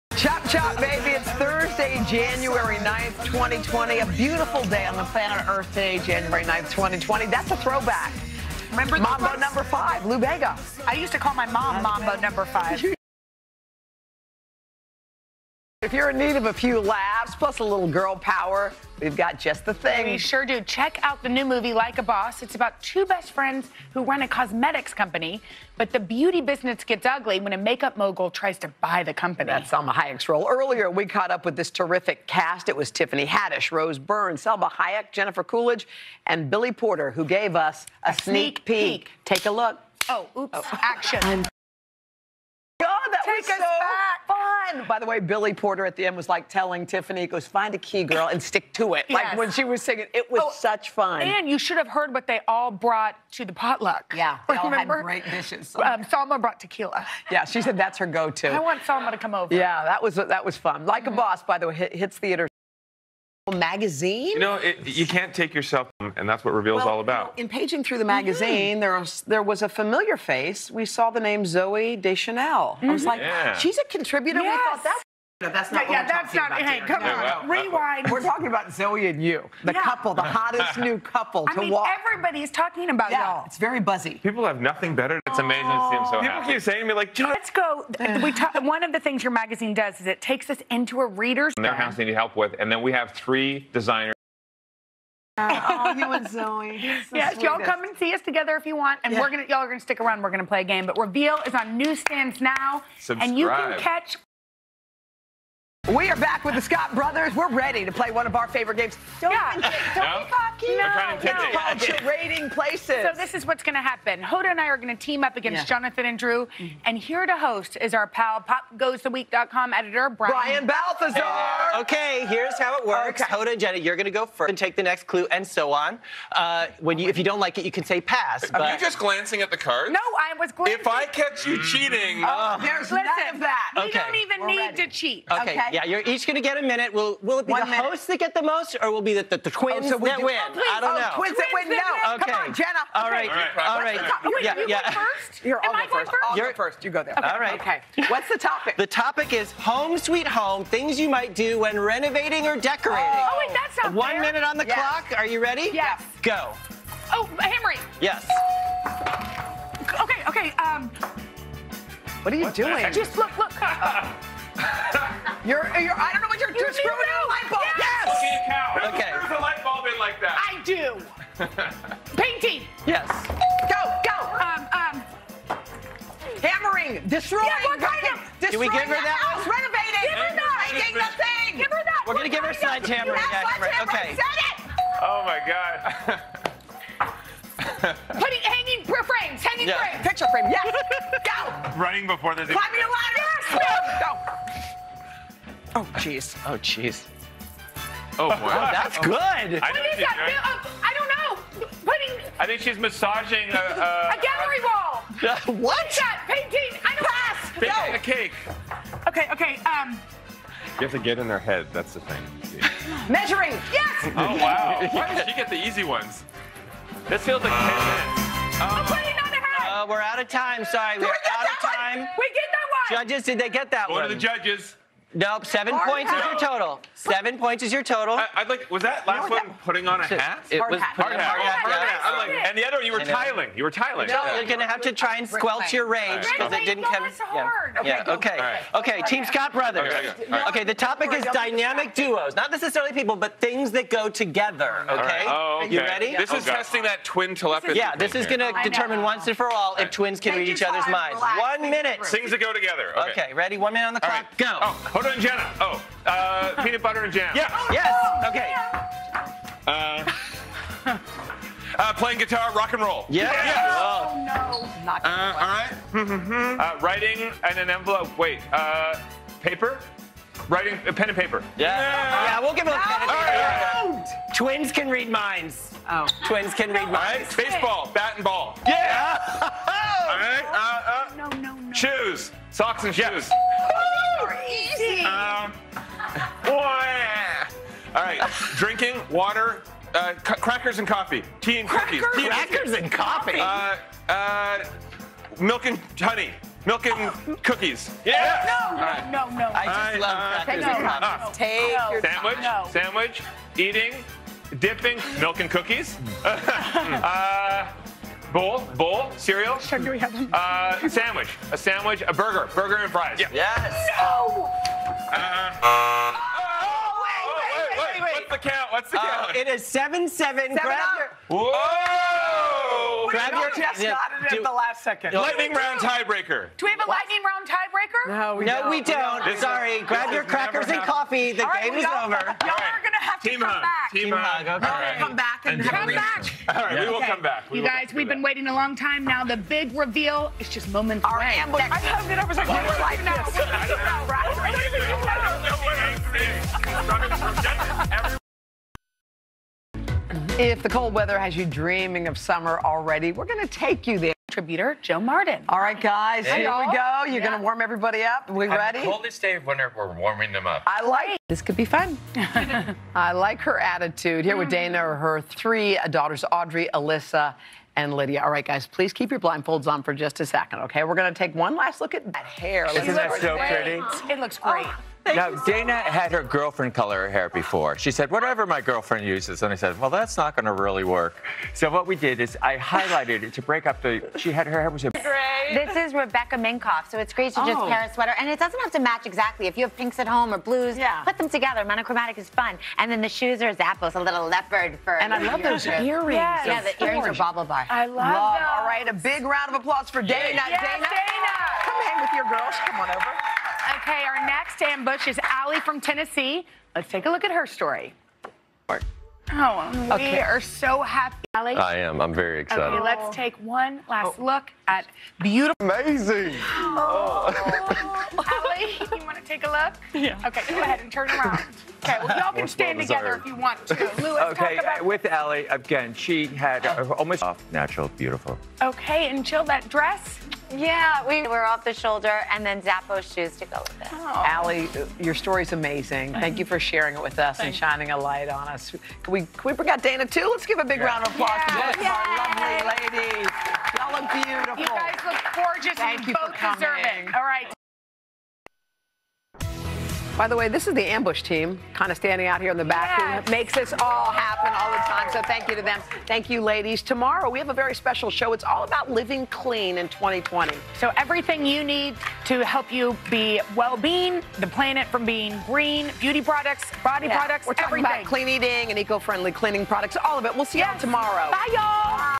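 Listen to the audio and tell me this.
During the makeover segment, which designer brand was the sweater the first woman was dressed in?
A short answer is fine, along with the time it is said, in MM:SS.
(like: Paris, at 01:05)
Rebecca Minkoff, at 06:25.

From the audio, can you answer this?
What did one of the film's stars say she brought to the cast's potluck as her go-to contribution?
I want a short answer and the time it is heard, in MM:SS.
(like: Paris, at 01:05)
Tequila, at 00:56.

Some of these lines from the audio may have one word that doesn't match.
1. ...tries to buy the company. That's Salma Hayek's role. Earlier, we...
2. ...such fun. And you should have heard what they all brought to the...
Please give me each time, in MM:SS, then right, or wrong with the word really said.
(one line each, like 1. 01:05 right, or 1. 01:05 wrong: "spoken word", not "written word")
1. 00:28 right
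2. 00:50 right.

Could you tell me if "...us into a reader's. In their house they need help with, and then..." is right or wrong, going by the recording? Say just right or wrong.
right.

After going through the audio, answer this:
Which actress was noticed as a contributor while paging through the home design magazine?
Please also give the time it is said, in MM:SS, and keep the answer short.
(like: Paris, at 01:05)
Zooey Deschanel, at 01:11.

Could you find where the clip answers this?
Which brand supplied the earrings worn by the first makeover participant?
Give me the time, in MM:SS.
06:37.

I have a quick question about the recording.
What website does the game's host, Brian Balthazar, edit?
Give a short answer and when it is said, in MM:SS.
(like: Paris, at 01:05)
PopGoesTheWeek.com, at 01:58.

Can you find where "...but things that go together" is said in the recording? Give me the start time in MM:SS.
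04:03.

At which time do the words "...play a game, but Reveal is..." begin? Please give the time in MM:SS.
01:40.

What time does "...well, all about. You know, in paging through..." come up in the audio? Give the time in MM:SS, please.
01:06.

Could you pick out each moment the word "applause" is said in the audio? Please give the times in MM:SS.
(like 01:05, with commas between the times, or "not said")
06:39, 07:21.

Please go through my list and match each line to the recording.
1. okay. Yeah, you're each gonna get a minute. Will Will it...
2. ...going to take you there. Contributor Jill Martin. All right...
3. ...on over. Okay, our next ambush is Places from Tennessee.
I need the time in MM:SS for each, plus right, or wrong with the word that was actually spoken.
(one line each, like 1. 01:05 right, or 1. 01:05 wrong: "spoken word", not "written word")
1. 02:15 right
2. 05:53 right
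3. 06:42 wrong: "Allie", not "Places".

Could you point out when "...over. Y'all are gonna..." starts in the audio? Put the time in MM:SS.
05:31.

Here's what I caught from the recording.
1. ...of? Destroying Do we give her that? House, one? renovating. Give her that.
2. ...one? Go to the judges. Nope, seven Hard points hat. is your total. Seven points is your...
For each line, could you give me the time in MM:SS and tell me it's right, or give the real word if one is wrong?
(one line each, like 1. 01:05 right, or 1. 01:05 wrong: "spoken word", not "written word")
1. 02:58 right
2. 03:43 right.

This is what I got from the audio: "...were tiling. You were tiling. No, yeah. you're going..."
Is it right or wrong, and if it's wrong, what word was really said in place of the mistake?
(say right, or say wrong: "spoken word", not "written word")
right.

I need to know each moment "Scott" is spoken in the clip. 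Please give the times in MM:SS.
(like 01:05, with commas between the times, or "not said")
01:46, 03:59.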